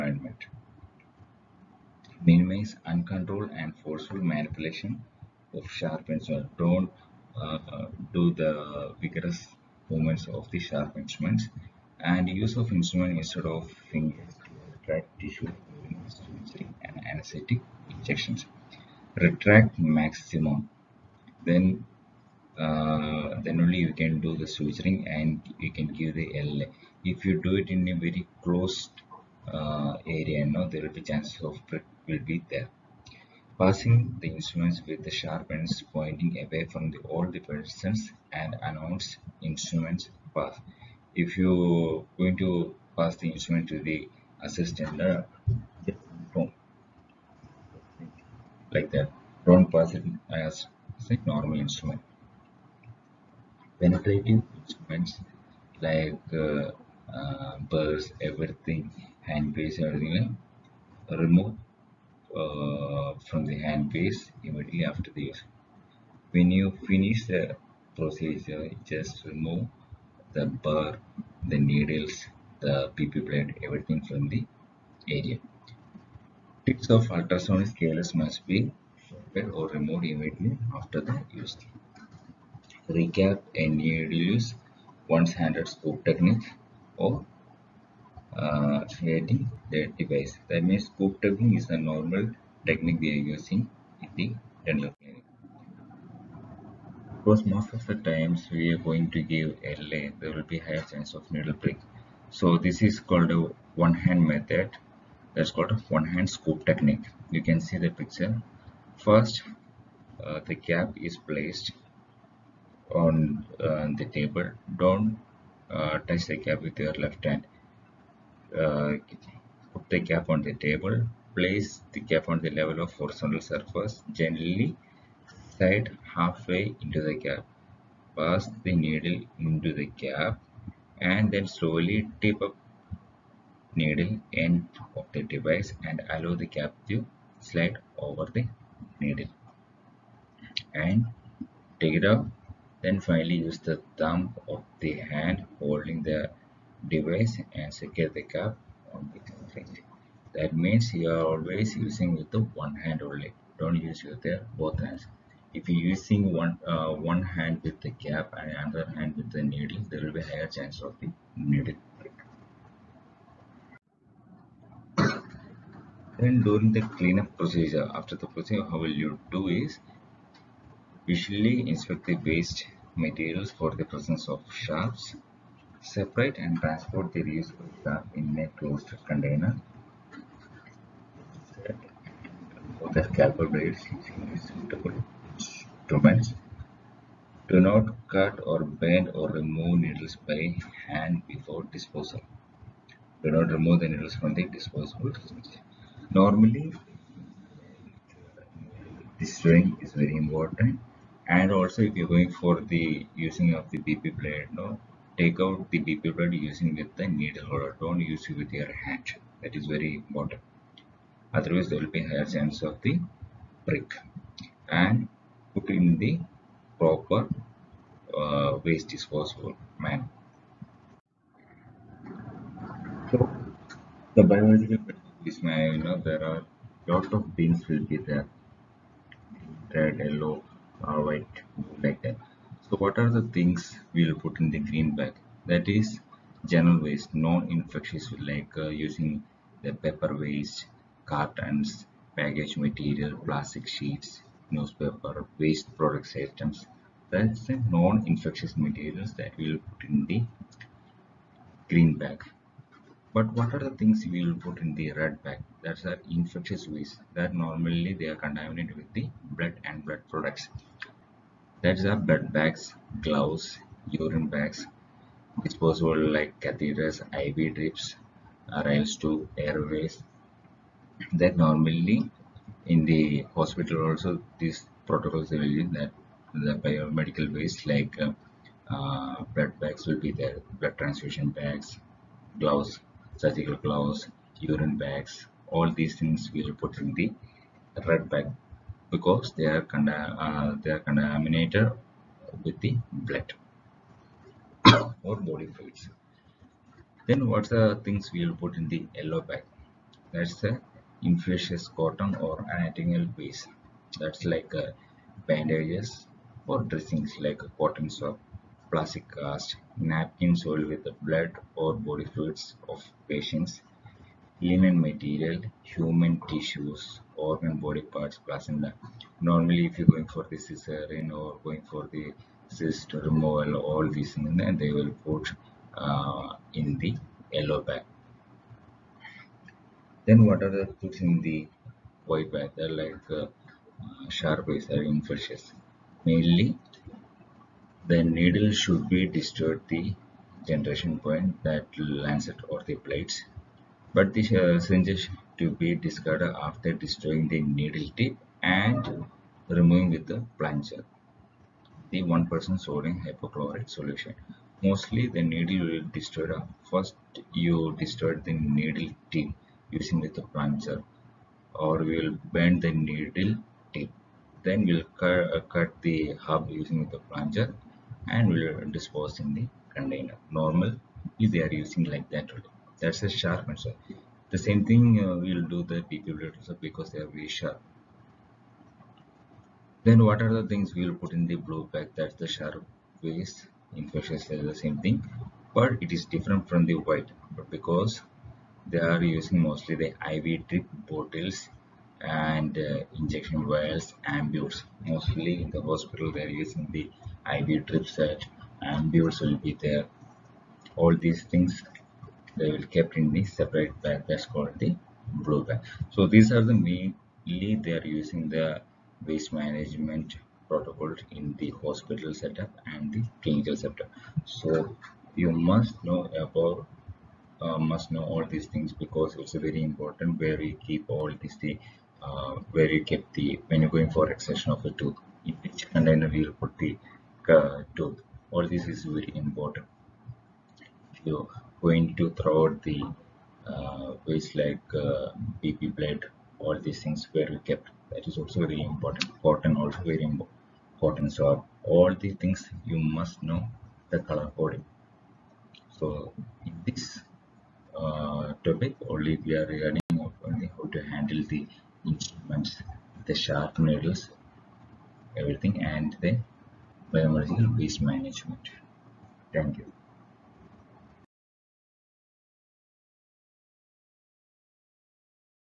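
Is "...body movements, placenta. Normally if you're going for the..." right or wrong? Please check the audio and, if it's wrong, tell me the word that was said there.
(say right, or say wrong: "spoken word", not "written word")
wrong: "parts", not "movements".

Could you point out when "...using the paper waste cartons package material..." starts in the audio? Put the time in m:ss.
3:58.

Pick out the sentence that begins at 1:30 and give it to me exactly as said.
That means scope tubing is a normal technique we are using in the dental clinic.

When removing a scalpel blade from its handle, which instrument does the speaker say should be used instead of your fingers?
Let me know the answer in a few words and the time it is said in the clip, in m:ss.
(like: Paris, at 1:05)
needle holder, at 3:27.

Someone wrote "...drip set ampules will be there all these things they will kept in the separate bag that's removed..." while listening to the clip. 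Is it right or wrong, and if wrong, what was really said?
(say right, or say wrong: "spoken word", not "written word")
wrong: "called", not "removed".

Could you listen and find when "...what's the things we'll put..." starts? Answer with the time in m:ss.
4:57.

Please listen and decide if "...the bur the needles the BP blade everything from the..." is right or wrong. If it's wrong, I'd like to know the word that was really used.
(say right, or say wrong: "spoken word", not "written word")
right.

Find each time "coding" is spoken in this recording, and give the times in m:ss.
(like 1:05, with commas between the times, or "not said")
7:24.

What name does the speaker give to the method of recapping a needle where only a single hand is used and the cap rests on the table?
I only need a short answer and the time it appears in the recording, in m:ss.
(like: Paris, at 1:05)
one hand scoop technique, at 1:45.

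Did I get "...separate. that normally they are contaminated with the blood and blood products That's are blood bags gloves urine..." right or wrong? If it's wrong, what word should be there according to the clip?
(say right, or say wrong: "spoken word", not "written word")
wrong: "waste", not "separate".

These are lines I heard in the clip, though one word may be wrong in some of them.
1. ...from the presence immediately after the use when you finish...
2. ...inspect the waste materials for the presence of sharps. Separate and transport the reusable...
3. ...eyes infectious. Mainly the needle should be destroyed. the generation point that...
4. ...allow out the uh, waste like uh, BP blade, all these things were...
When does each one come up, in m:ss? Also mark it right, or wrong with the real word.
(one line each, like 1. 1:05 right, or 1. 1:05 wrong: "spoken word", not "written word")
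1. 1:03 wrong: "handpiece", not "presence"
2. 2:51 right
3. 5:34 right
4. 7:12 wrong: "throw", not "allow".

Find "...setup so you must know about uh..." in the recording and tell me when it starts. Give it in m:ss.
6:53.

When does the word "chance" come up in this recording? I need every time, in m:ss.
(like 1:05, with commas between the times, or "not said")
0:31, 1:40, 2:40, 3:32.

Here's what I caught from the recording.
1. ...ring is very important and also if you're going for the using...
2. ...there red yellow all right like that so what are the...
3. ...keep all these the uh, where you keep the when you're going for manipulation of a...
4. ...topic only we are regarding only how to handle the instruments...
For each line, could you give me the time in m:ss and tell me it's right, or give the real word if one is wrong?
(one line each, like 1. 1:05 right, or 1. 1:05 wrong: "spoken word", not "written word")
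1. 3:19 right
2. 3:48 right
3. 7:00 wrong: "extraction", not "manipulation"
4. 7:28 right.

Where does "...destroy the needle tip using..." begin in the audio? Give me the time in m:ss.
5:57.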